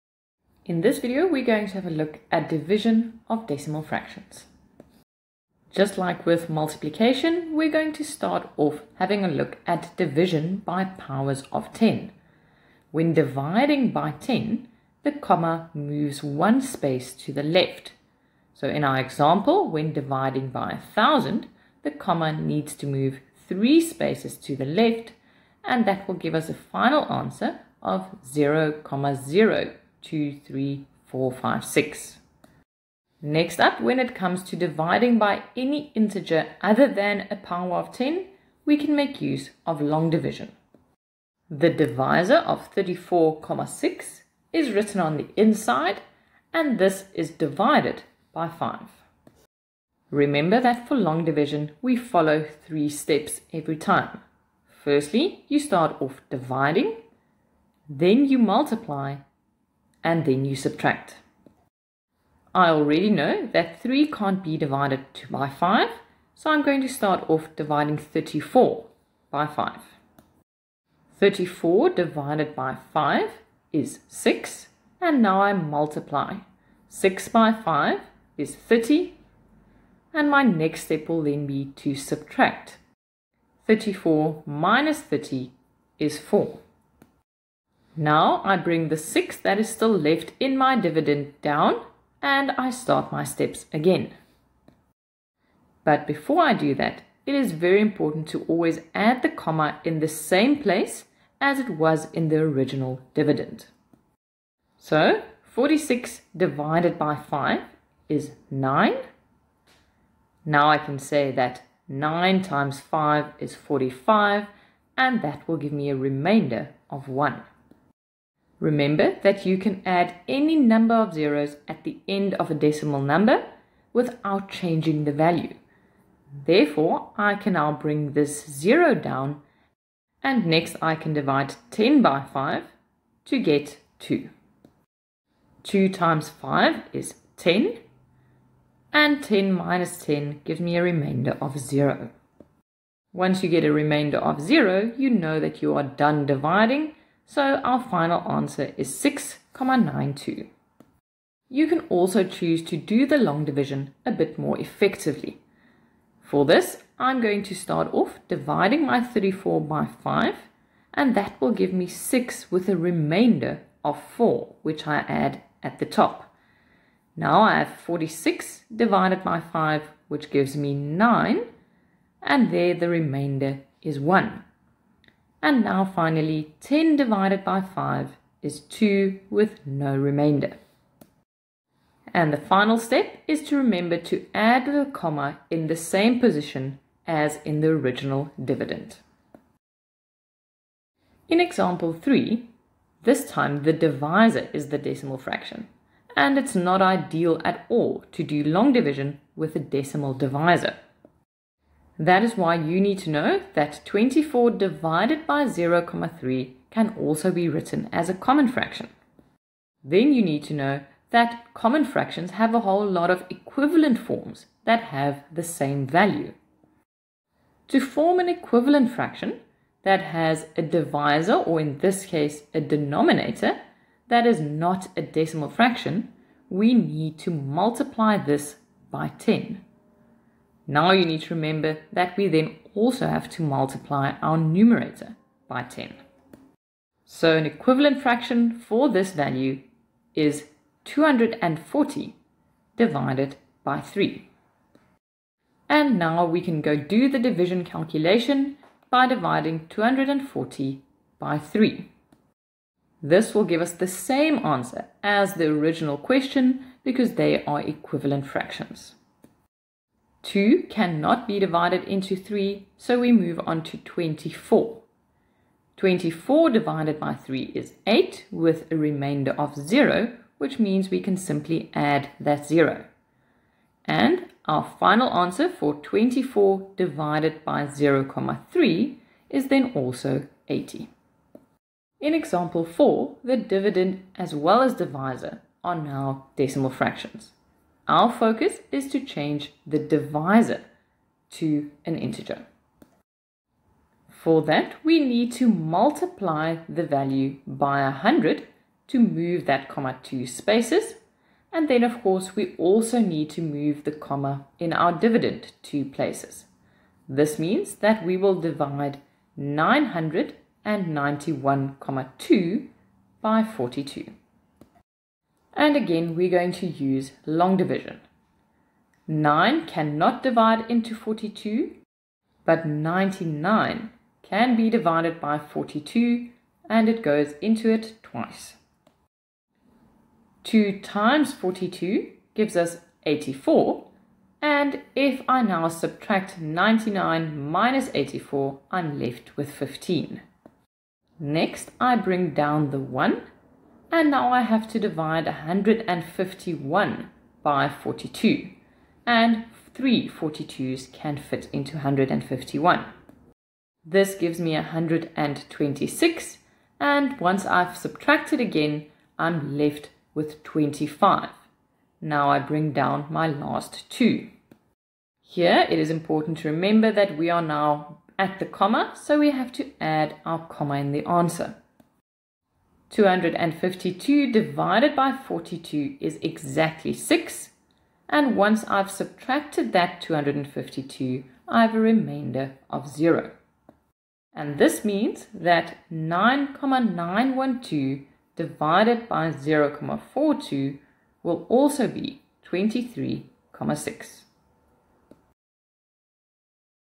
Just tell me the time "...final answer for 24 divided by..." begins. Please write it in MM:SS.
04:34.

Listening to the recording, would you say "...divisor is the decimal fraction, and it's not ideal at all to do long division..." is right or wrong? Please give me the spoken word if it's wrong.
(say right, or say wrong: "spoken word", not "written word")
right.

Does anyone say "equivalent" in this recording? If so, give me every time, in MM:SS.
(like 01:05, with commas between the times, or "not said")
03:33, 03:38, 03:57, 04:17.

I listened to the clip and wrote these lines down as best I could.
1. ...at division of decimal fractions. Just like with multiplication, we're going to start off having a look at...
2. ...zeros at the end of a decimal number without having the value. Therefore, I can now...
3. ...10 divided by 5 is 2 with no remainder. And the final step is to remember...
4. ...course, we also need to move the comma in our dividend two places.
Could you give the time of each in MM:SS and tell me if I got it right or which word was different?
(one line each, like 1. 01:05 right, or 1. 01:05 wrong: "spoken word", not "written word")
1. 00:02 right
2. 02:01 wrong: "changing", not "having"
3. 02:56 right
4. 05:02 right.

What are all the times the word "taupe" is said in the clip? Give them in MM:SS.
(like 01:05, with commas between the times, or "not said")
not said.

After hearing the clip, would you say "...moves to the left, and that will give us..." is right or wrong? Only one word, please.
wrong.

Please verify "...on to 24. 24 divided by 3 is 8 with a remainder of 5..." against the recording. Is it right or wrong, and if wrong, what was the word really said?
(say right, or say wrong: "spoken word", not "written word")
wrong: "0", not "5".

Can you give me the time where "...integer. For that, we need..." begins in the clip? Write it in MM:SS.
04:51.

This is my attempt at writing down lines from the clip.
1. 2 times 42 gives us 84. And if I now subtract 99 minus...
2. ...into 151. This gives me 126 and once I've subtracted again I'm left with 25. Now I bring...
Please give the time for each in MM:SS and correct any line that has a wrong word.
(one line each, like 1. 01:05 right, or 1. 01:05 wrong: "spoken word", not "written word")
1. 05:30 right
2. 05:51 right.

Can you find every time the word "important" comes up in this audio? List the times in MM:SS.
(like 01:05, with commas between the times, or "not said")
01:37, 06:05.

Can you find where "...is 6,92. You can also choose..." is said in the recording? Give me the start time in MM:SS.
02:28.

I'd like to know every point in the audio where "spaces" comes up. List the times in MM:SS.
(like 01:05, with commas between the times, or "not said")
00:16, 00:23, 05:00.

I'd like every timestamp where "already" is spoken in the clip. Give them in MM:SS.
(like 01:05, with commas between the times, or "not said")
01:02.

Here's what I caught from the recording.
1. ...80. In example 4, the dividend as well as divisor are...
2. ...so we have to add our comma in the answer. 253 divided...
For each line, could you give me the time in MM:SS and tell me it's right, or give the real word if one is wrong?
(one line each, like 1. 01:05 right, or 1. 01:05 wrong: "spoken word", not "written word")
1. 04:40 right
2. 06:09 wrong: "252", not "253".